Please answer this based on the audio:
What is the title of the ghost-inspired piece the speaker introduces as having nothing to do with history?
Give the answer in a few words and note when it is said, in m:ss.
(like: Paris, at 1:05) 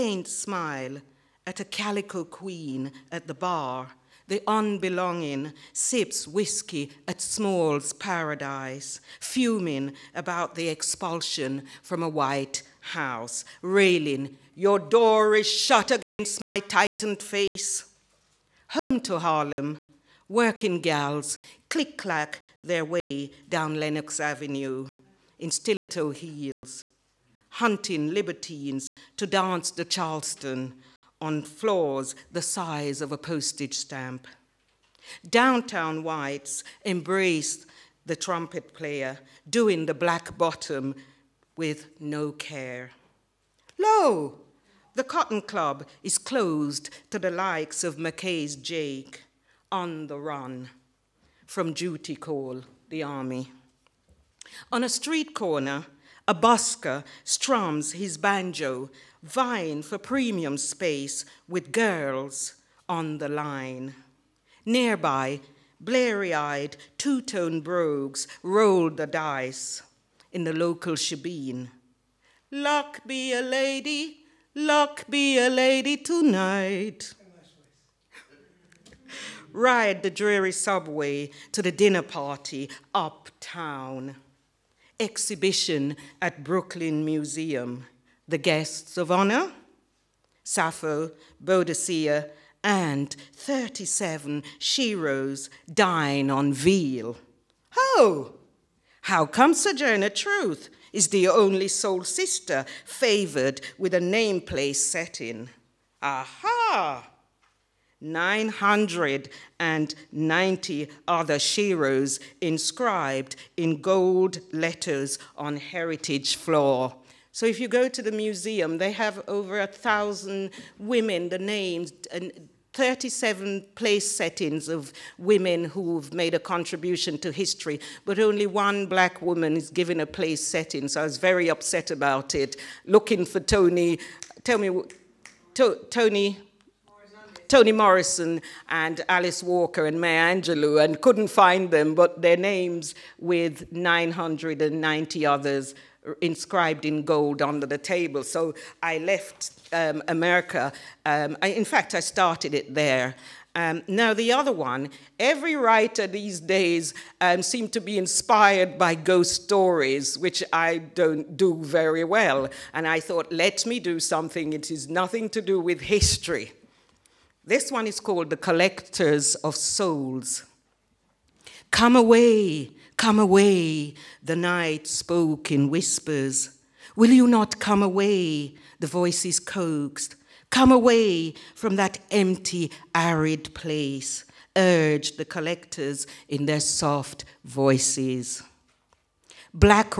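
The Collectors of Souls, at 2:48.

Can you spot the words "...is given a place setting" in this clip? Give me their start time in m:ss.
2:09.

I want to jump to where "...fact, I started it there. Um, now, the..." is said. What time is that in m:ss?
2:31.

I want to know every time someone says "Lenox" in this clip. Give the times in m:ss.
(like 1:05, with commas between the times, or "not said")
0:23.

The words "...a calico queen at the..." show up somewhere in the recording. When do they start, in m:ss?
0:01.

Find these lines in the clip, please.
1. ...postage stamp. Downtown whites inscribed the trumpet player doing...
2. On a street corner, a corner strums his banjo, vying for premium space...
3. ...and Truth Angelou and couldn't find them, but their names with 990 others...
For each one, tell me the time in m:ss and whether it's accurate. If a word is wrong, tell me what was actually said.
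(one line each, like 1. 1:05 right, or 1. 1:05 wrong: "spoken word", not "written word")
1. 0:33 wrong: "embraced", not "inscribed"
2. 0:54 wrong: "busker", not "corner"
3. 2:19 wrong: "Maya", not "Truth".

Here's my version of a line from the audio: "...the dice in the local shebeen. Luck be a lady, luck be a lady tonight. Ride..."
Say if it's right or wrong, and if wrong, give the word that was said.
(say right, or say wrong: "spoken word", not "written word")
right.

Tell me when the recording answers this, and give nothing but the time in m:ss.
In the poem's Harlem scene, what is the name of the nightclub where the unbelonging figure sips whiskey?
0:07.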